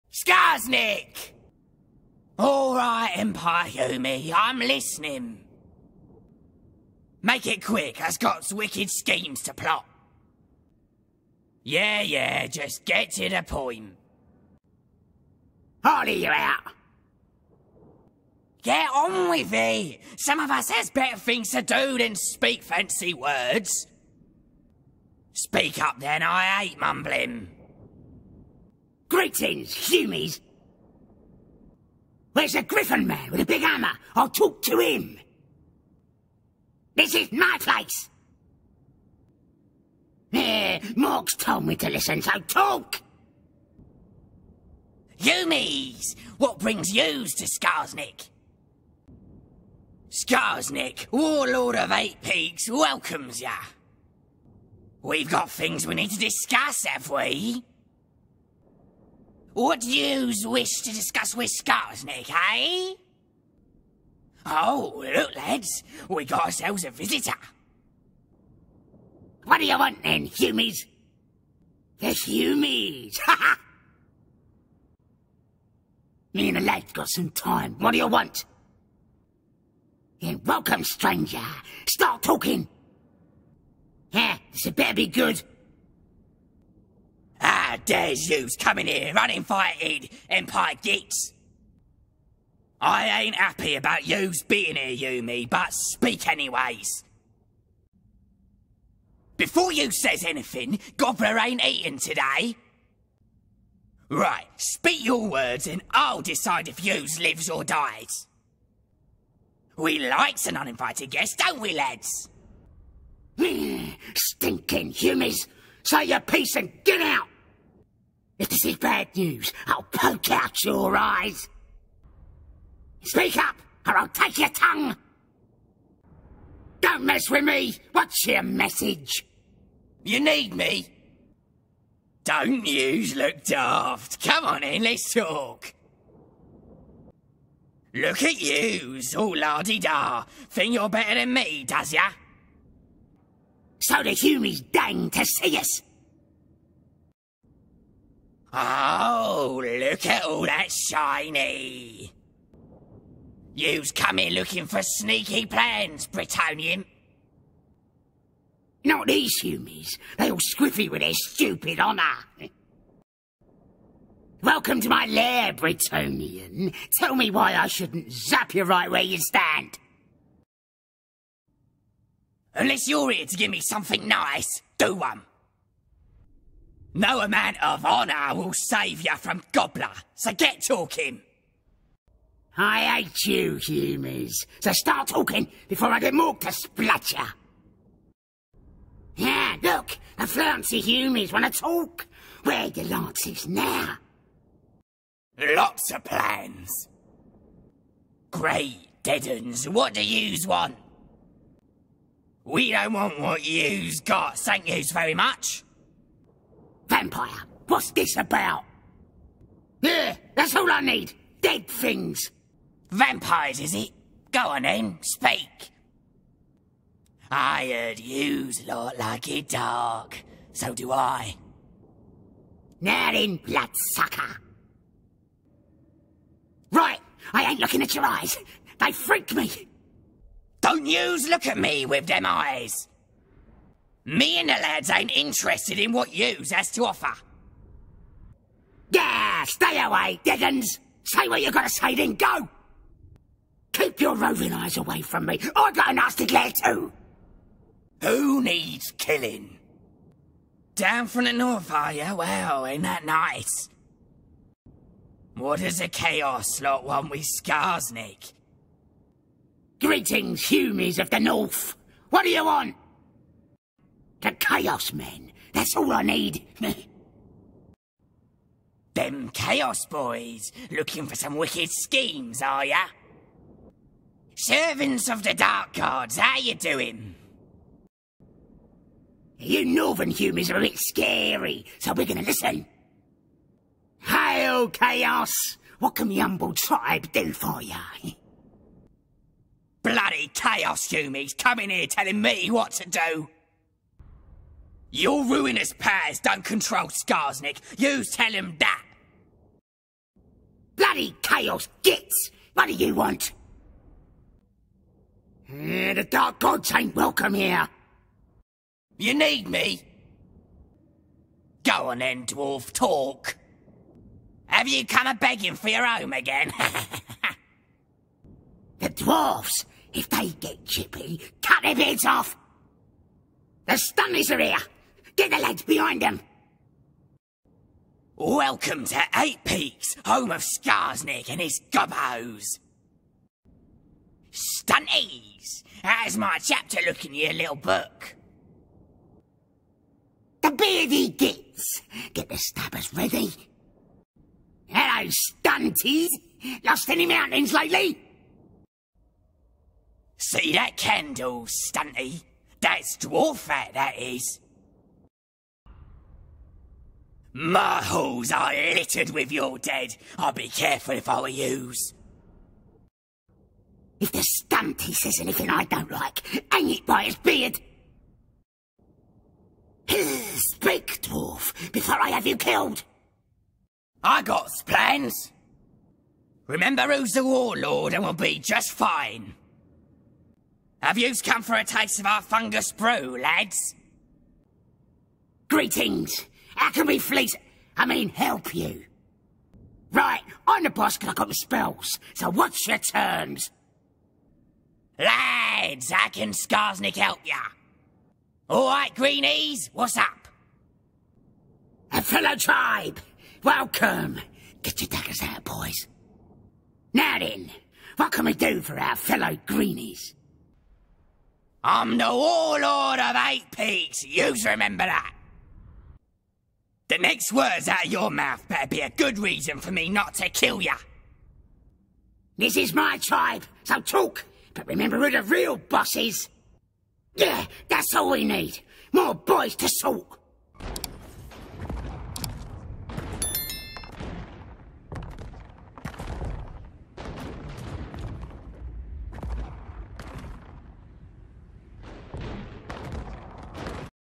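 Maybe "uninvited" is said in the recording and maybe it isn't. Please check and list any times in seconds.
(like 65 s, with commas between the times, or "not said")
89 s, 110 s.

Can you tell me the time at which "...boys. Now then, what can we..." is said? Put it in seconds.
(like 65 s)
405 s.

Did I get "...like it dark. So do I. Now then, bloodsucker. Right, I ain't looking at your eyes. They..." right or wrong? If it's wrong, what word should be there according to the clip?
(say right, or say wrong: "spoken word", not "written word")
right.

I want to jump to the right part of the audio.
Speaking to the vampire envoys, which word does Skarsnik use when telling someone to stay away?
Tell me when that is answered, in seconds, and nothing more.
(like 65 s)
240 s.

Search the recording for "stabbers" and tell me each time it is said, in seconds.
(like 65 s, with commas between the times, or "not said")
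342 s.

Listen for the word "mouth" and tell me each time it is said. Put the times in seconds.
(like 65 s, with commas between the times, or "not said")
418 s.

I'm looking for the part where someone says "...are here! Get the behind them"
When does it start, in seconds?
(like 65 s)
324 s.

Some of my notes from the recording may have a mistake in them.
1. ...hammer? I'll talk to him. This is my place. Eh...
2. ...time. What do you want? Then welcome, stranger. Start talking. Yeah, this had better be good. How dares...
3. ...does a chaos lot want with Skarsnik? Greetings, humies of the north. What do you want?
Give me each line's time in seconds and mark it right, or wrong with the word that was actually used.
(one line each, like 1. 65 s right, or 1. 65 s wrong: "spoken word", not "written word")
1. 33 s right
2. 77 s right
3. 255 s right.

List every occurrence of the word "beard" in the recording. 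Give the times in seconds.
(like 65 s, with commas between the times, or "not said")
340 s, 367 s.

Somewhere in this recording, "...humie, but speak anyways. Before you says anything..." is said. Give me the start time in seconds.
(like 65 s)
95 s.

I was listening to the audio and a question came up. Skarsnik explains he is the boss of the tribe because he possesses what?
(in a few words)
the spells.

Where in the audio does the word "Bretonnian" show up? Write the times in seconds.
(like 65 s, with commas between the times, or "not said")
156 s, 165 s.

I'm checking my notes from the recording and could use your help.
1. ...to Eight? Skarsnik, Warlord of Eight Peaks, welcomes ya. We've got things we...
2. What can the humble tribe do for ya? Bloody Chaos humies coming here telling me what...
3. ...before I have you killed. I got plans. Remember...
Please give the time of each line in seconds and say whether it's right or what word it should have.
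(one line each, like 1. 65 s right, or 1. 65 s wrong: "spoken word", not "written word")
1. 47 s wrong: "Skarsnik", not "Eight"
2. 285 s right
3. 371 s right.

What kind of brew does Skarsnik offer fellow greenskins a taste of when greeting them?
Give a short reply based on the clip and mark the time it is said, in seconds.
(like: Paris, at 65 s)
fungus brew, at 382 s.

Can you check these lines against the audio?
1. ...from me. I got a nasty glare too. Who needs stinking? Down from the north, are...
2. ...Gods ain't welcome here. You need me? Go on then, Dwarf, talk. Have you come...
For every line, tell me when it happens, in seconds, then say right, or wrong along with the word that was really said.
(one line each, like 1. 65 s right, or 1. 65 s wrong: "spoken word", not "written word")
1. 245 s wrong: "killing", not "stinking"
2. 306 s right.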